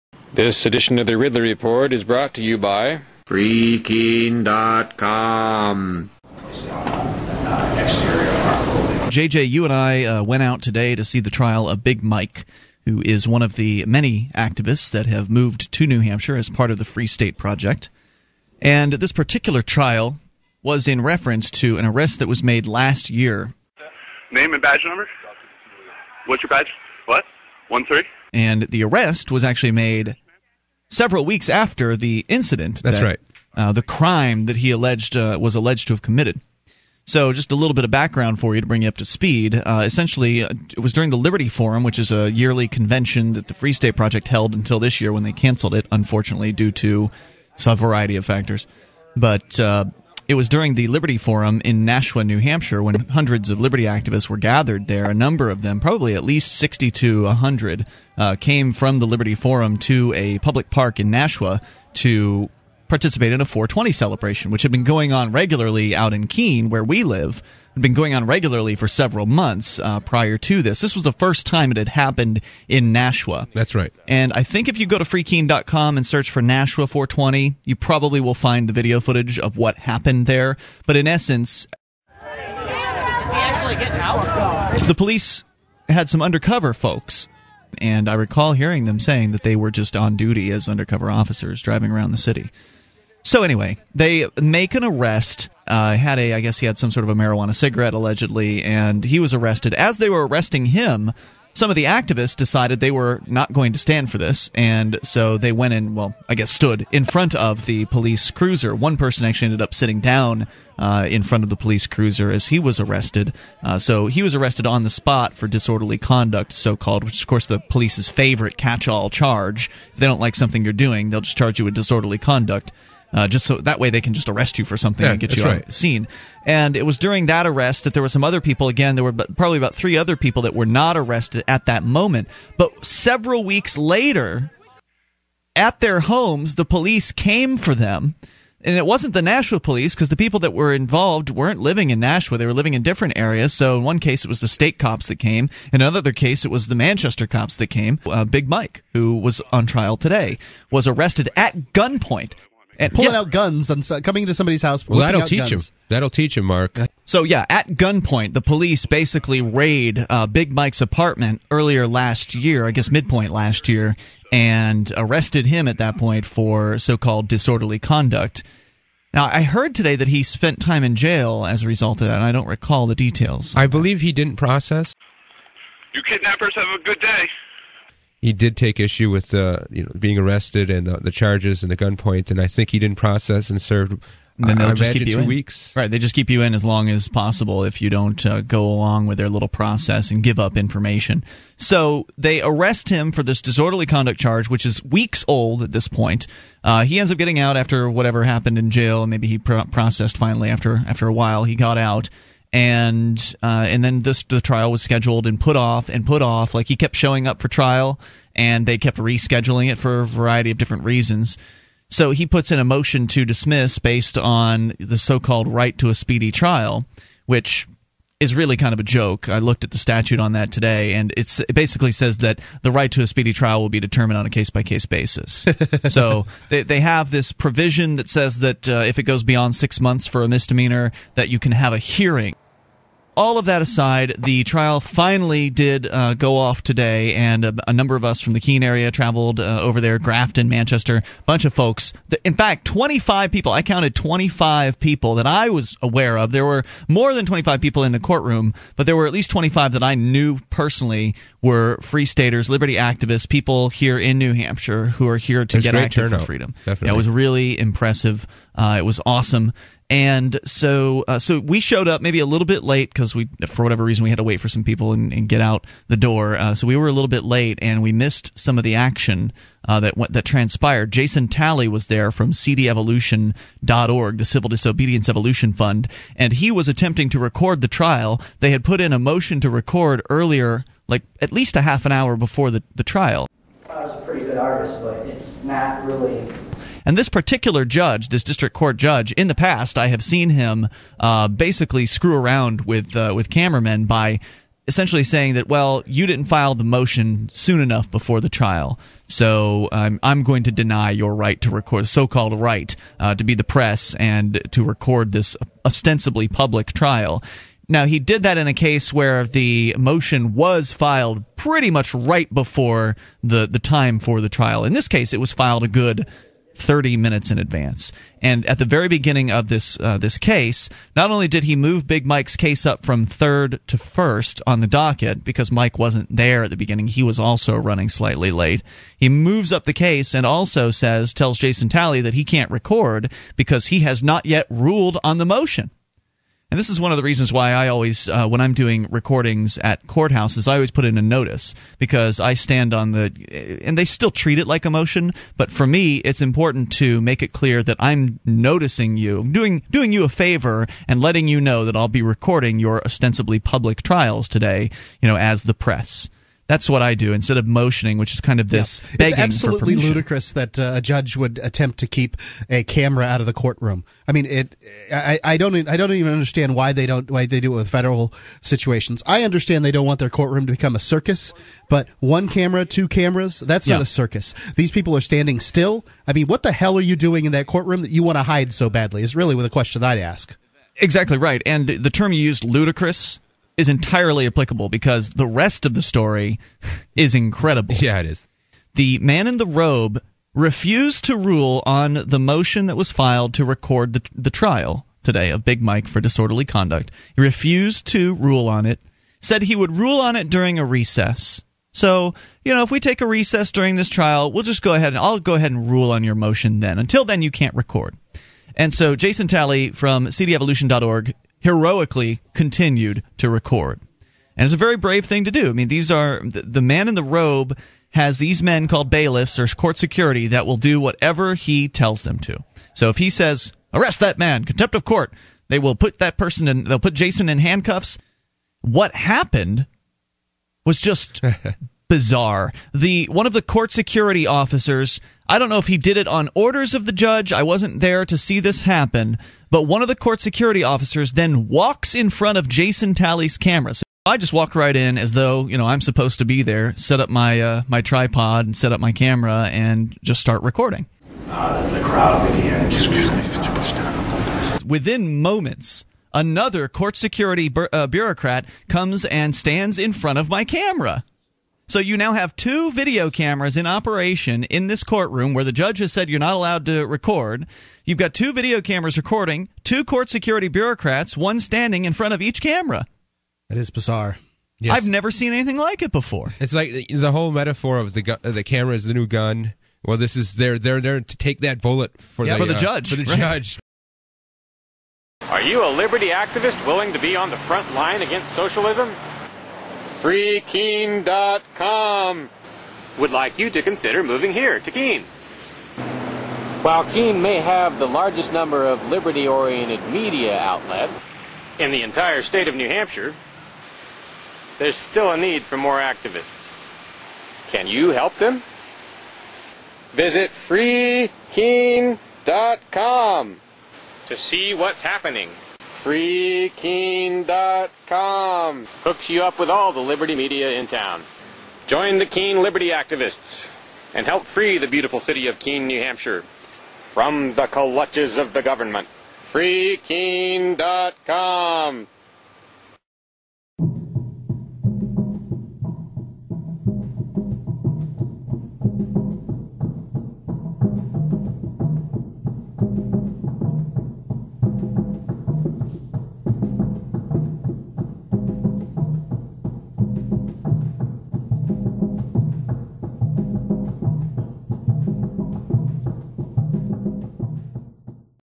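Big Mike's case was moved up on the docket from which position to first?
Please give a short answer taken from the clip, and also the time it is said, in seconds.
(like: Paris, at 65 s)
third, at 323 s.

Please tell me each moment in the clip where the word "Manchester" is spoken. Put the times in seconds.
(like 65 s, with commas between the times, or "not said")
146 s, 240 s.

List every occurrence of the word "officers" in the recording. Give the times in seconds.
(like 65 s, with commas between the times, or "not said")
91 s, 434 s, 440 s.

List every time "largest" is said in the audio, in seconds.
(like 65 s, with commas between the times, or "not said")
497 s.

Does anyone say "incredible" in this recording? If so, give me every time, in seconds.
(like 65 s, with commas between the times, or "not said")
387 s.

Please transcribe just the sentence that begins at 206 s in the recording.
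Like he kept showing up for trial, and they kept rescheduling it for a variety of different reasons.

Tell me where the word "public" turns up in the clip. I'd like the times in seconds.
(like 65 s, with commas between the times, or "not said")
60 s, 306 s, 353 s.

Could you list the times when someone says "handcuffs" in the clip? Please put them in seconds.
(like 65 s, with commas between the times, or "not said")
427 s.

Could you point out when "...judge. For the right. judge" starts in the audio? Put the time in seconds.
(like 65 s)
482 s.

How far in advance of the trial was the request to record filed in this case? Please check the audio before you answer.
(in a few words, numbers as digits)
30 minutes.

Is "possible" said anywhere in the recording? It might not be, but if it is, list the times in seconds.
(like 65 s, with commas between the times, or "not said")
187 s.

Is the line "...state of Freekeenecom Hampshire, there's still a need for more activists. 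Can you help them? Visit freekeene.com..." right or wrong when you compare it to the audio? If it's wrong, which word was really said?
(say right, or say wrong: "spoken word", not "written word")
wrong: "New", not "Freekeenecom".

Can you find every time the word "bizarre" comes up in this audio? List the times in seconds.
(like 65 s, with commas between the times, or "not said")
431 s, 473 s.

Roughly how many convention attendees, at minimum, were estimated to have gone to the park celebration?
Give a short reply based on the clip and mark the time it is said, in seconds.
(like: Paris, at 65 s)
60, at 56 s.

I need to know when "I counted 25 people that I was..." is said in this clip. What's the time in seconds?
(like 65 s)
243 s.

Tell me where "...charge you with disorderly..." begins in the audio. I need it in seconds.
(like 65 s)
121 s.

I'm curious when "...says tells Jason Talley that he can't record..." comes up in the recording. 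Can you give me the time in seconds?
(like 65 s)
330 s.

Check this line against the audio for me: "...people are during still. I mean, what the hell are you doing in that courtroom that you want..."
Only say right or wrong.
wrong.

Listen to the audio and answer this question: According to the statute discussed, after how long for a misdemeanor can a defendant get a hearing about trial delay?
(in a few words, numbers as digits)
6 months.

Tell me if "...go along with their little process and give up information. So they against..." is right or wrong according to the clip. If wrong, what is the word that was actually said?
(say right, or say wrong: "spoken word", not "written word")
wrong: "arrest", not "against".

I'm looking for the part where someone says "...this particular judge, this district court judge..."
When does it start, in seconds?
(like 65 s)
286 s.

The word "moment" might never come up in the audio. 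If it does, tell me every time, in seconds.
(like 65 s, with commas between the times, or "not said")
131 s, 455 s.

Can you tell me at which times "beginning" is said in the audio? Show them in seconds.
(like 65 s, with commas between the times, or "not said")
318 s, 326 s.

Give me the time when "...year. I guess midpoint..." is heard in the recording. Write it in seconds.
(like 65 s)
162 s.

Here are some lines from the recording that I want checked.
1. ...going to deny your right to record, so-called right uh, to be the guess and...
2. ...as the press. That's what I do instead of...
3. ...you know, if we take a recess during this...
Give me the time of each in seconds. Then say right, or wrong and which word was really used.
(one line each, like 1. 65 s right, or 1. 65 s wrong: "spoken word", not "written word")
1. 300 s wrong: "press", not "guess"
2. 355 s right
3. 402 s right.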